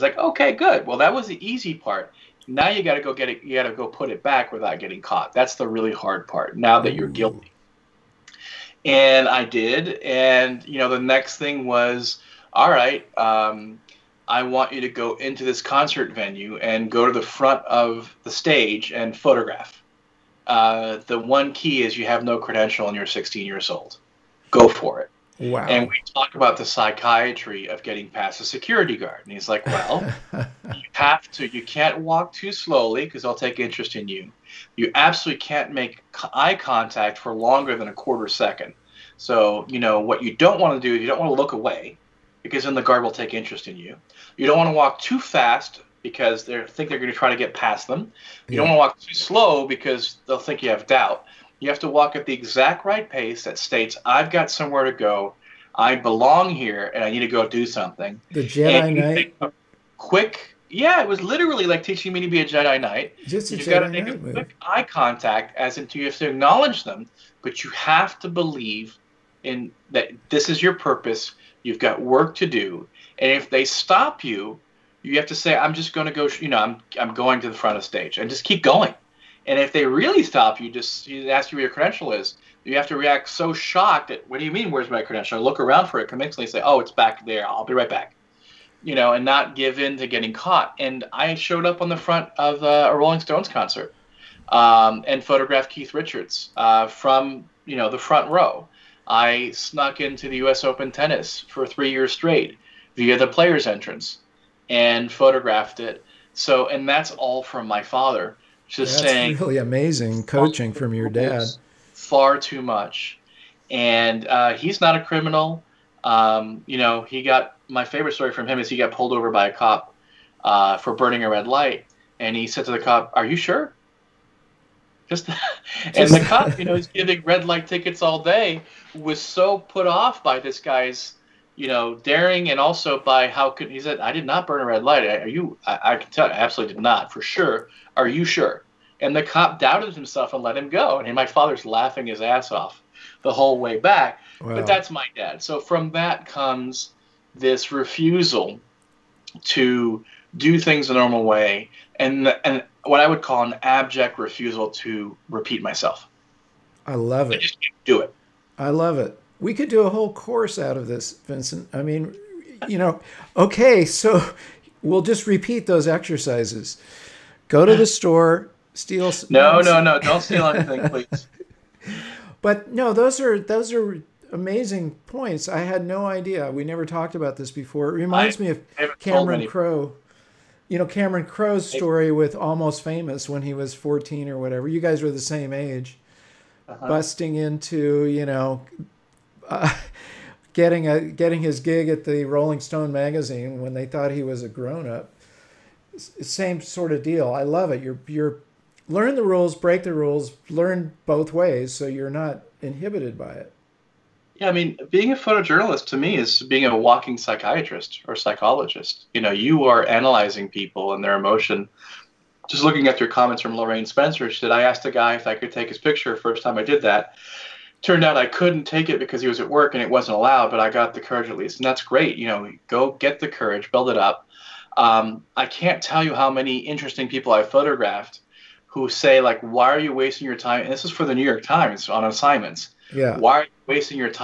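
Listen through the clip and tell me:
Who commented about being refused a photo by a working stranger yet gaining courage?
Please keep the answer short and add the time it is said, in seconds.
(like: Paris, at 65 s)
Lorraine Spencer, at 213 s.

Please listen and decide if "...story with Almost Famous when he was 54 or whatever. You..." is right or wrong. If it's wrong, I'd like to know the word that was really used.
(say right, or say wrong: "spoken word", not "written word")
wrong: "14", not "54".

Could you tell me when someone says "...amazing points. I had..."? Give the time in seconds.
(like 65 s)
174 s.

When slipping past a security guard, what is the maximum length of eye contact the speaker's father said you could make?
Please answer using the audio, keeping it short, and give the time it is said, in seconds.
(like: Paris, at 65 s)
a quarter second, at 37 s.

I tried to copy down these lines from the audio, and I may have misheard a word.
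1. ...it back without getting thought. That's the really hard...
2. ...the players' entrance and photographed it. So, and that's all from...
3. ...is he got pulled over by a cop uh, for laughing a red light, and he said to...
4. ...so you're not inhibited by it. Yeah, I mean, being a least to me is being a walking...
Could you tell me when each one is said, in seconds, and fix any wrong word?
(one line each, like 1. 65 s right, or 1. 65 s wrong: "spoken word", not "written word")
1. 4 s wrong: "caught", not "thought"
2. 103 s right
3. 118 s wrong: "burning", not "laughing"
4. 201 s wrong: "photojournalist", not "least".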